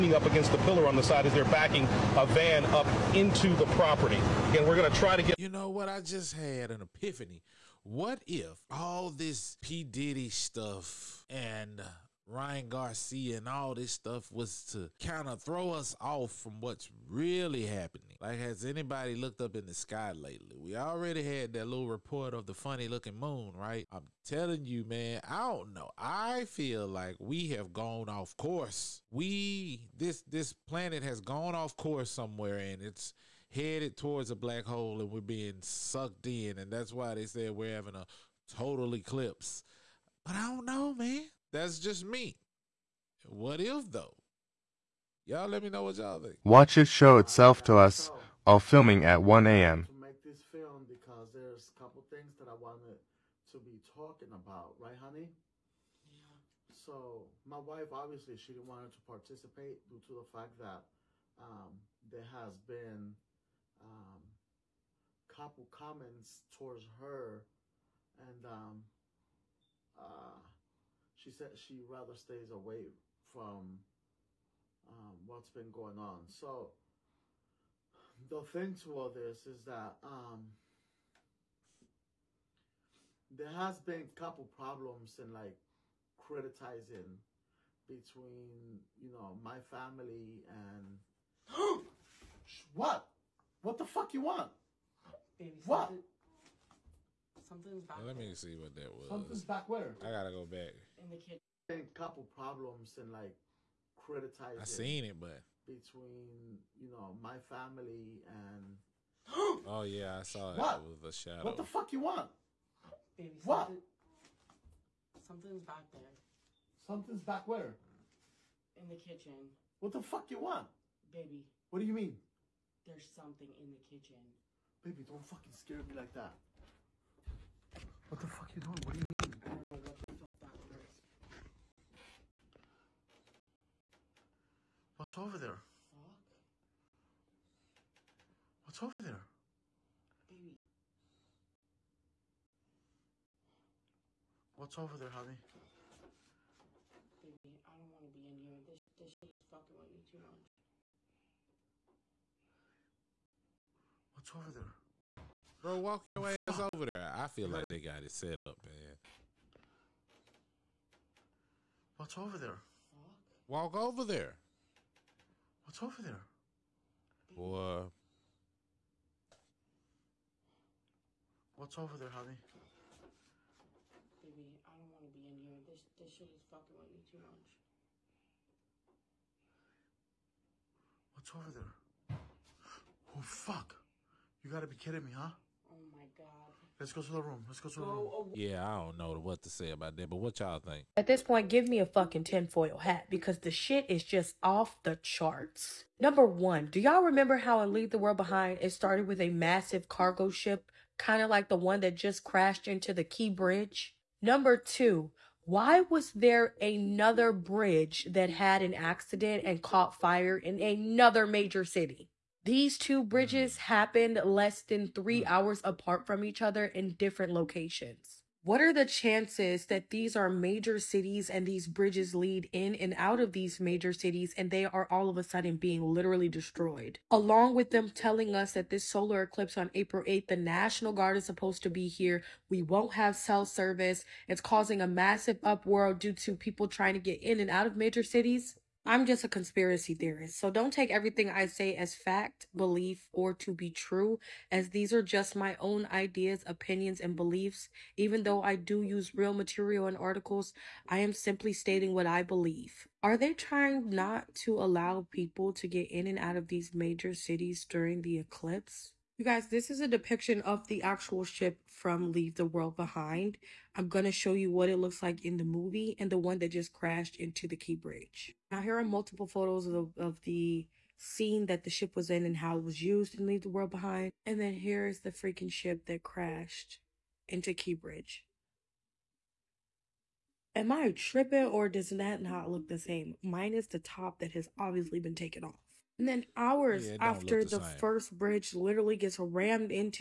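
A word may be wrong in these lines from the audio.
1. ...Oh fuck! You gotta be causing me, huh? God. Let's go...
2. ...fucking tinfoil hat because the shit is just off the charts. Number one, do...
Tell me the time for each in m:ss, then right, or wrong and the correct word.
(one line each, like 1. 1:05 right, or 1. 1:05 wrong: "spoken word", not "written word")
1. 3:03 wrong: "kidding", not "causing"
2. 3:11 right.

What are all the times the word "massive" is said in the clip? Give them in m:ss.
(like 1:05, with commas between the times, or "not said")
3:19, 3:54.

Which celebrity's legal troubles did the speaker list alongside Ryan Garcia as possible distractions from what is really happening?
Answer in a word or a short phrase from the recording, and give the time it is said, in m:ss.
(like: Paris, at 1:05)
P. Diddy, at 0:09.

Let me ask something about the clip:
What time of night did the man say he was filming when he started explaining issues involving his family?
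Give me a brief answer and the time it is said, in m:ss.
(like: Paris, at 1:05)
1 a.m., at 0:49.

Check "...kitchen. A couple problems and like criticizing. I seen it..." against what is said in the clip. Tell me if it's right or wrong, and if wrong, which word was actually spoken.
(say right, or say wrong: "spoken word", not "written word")
right.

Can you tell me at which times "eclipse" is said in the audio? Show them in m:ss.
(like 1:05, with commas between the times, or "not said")
0:38, 3:49, 4:18.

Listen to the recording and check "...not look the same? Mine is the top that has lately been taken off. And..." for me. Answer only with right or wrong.
wrong.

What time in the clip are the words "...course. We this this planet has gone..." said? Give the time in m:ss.
0:28.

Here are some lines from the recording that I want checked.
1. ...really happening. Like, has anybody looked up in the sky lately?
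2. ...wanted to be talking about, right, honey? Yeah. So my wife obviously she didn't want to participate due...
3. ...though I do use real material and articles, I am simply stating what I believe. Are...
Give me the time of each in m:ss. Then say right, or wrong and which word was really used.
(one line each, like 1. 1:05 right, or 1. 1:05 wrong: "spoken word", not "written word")
1. 0:17 right
2. 0:52 right
3. 4:08 right.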